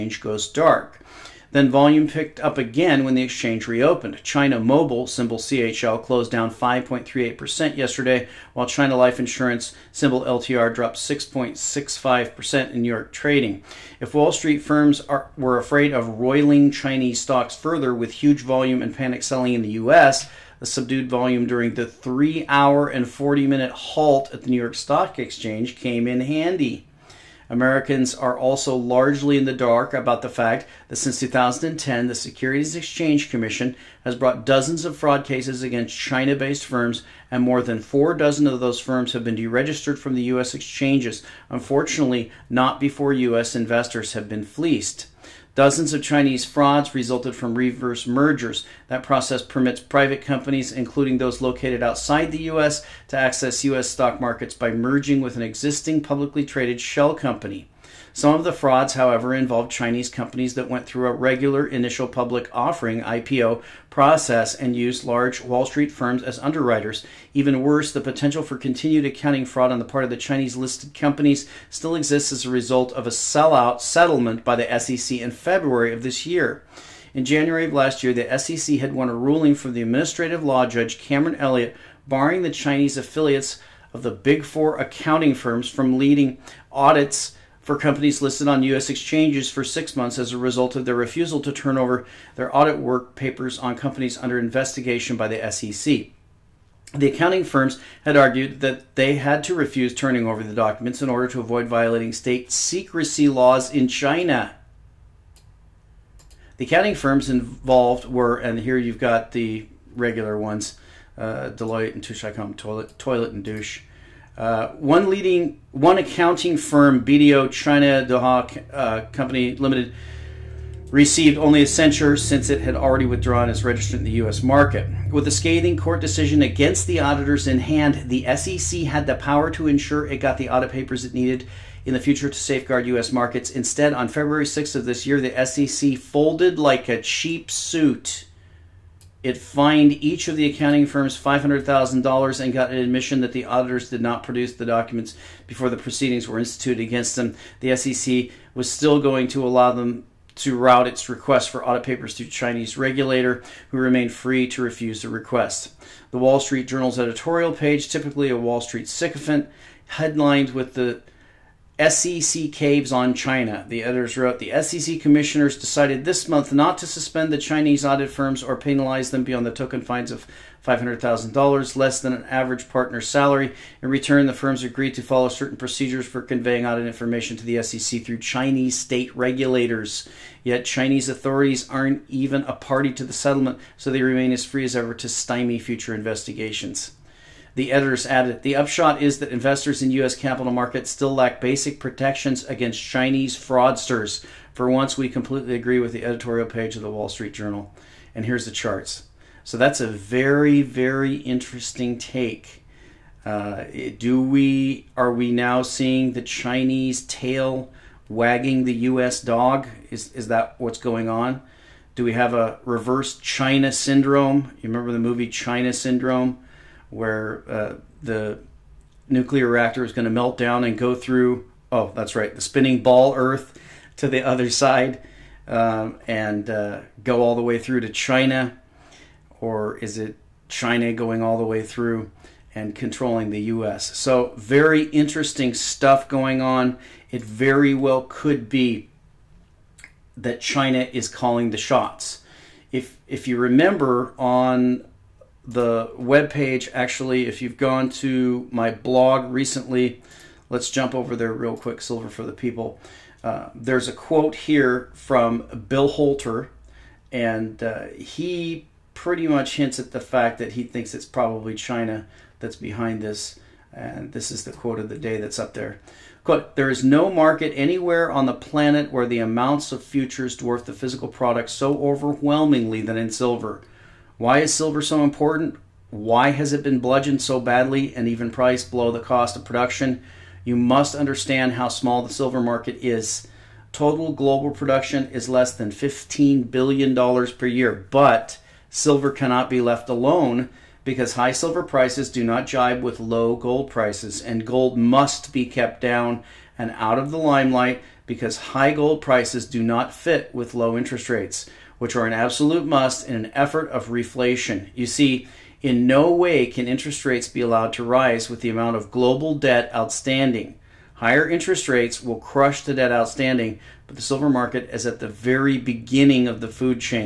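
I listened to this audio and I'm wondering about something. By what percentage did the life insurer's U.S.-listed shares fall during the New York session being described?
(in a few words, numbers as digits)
6.65%.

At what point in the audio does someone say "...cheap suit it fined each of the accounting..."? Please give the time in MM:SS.
02:17.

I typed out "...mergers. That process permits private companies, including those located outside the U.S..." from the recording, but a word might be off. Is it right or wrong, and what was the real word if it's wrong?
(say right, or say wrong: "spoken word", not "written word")
right.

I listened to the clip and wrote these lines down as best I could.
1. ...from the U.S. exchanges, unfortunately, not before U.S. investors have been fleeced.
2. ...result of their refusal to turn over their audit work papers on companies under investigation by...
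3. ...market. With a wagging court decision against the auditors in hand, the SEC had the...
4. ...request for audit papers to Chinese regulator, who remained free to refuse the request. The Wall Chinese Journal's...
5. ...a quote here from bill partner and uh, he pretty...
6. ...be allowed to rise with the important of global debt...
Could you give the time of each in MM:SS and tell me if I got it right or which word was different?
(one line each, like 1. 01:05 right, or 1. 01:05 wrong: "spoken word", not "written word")
1. 00:39 right
2. 01:30 right
3. 02:04 wrong: "scathing", not "wagging"
4. 02:31 wrong: "Street", not "Chinese"
5. 04:13 wrong: "holter", not "partner"
6. 05:07 wrong: "amount", not "important".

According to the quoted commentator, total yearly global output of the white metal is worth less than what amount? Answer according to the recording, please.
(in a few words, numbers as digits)
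$15 billion.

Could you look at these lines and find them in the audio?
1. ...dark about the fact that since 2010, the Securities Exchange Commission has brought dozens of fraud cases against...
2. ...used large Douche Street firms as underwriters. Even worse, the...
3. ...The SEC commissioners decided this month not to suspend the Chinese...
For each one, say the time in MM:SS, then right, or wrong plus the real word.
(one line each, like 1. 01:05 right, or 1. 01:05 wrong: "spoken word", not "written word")
1. 00:29 right
2. 01:04 wrong: "Wall", not "Douche"
3. 02:44 right.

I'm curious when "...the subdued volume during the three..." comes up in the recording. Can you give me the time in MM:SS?
00:20.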